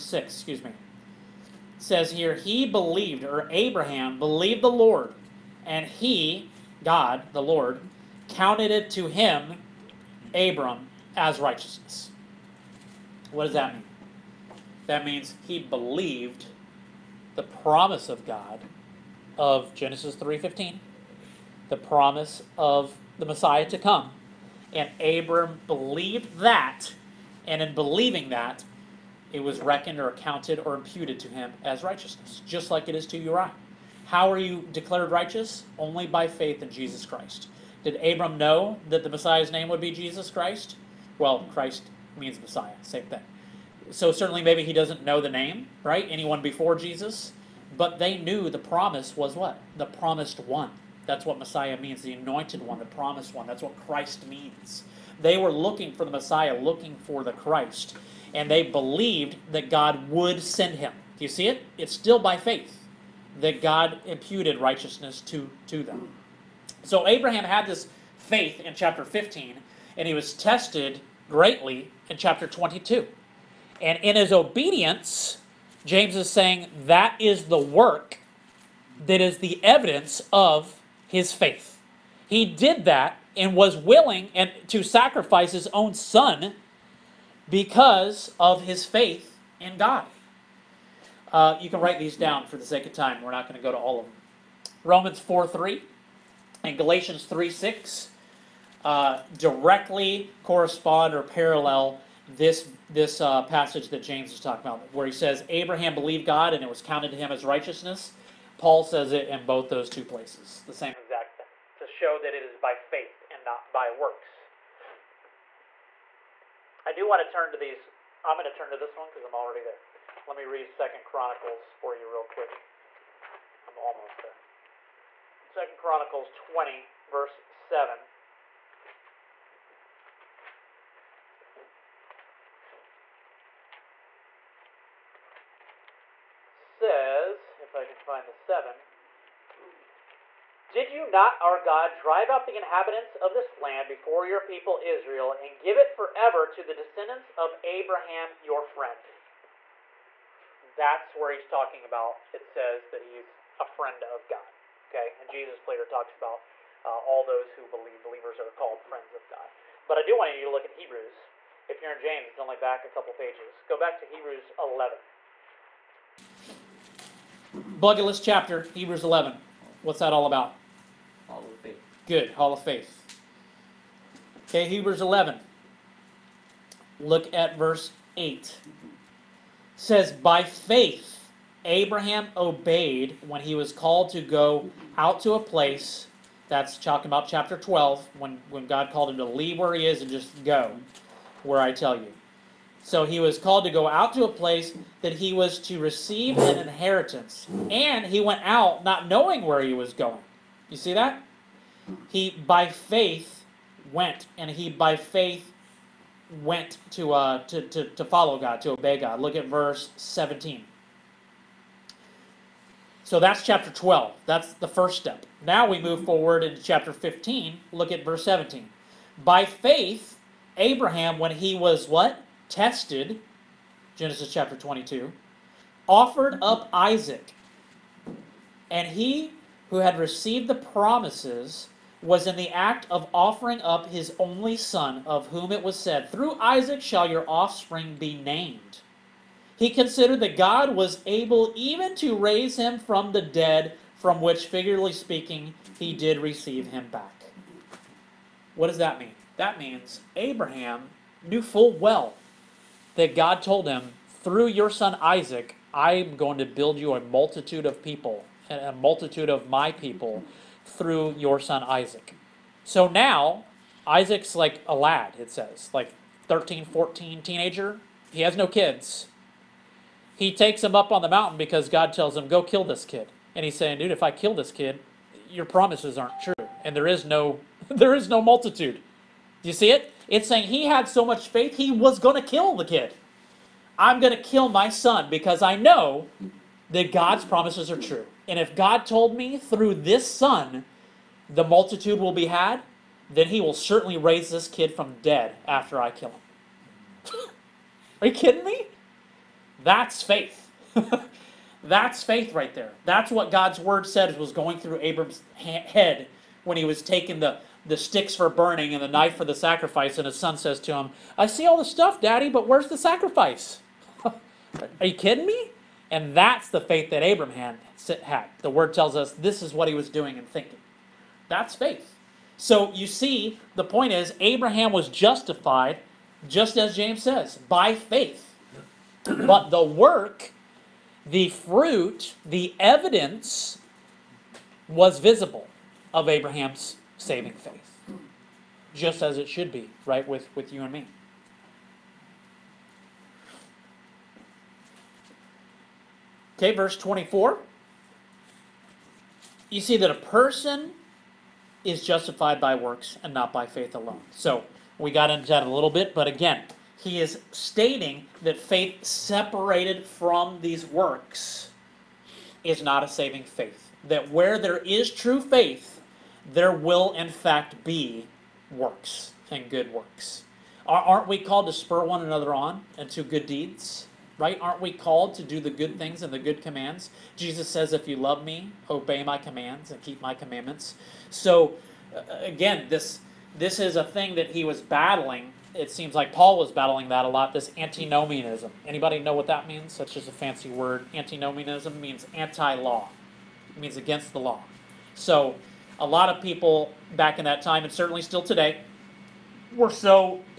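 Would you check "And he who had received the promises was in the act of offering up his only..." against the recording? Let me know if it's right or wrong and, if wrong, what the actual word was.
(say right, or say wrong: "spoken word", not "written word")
right.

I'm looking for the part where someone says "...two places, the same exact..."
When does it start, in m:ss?
1:49.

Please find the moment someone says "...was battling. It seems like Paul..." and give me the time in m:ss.
6:24.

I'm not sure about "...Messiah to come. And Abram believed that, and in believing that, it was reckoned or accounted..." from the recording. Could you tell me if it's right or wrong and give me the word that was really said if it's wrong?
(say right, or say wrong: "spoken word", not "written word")
right.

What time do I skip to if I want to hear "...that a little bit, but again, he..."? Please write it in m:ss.
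5:55.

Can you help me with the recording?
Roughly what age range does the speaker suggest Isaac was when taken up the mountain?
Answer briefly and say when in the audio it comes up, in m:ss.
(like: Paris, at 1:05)
13 or 14, at 4:25.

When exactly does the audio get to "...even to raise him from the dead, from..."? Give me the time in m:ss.
4:01.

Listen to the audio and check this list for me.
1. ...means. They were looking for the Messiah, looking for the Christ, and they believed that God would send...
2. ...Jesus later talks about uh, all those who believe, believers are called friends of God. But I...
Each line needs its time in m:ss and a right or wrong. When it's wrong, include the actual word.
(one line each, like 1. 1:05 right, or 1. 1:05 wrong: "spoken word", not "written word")
1. 0:54 right
2. 2:35 right.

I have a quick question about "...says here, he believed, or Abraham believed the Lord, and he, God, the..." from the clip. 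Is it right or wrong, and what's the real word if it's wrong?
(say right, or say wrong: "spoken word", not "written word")
right.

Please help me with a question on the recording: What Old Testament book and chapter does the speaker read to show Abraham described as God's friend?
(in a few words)
Second Chronicles 20.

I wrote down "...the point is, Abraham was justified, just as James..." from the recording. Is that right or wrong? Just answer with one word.
right.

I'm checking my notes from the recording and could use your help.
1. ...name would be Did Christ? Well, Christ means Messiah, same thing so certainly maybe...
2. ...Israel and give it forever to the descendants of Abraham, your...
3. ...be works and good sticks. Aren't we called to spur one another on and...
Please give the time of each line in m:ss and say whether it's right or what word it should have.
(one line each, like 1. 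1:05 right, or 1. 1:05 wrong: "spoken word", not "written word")
1. 0:39 wrong: "Jesus", not "Did"
2. 2:24 right
3. 6:07 wrong: "works", not "sticks".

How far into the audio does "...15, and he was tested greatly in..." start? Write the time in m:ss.
1:09.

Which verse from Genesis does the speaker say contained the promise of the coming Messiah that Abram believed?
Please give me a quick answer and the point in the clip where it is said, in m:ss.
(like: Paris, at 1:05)
Genesis 3:15, at 0:19.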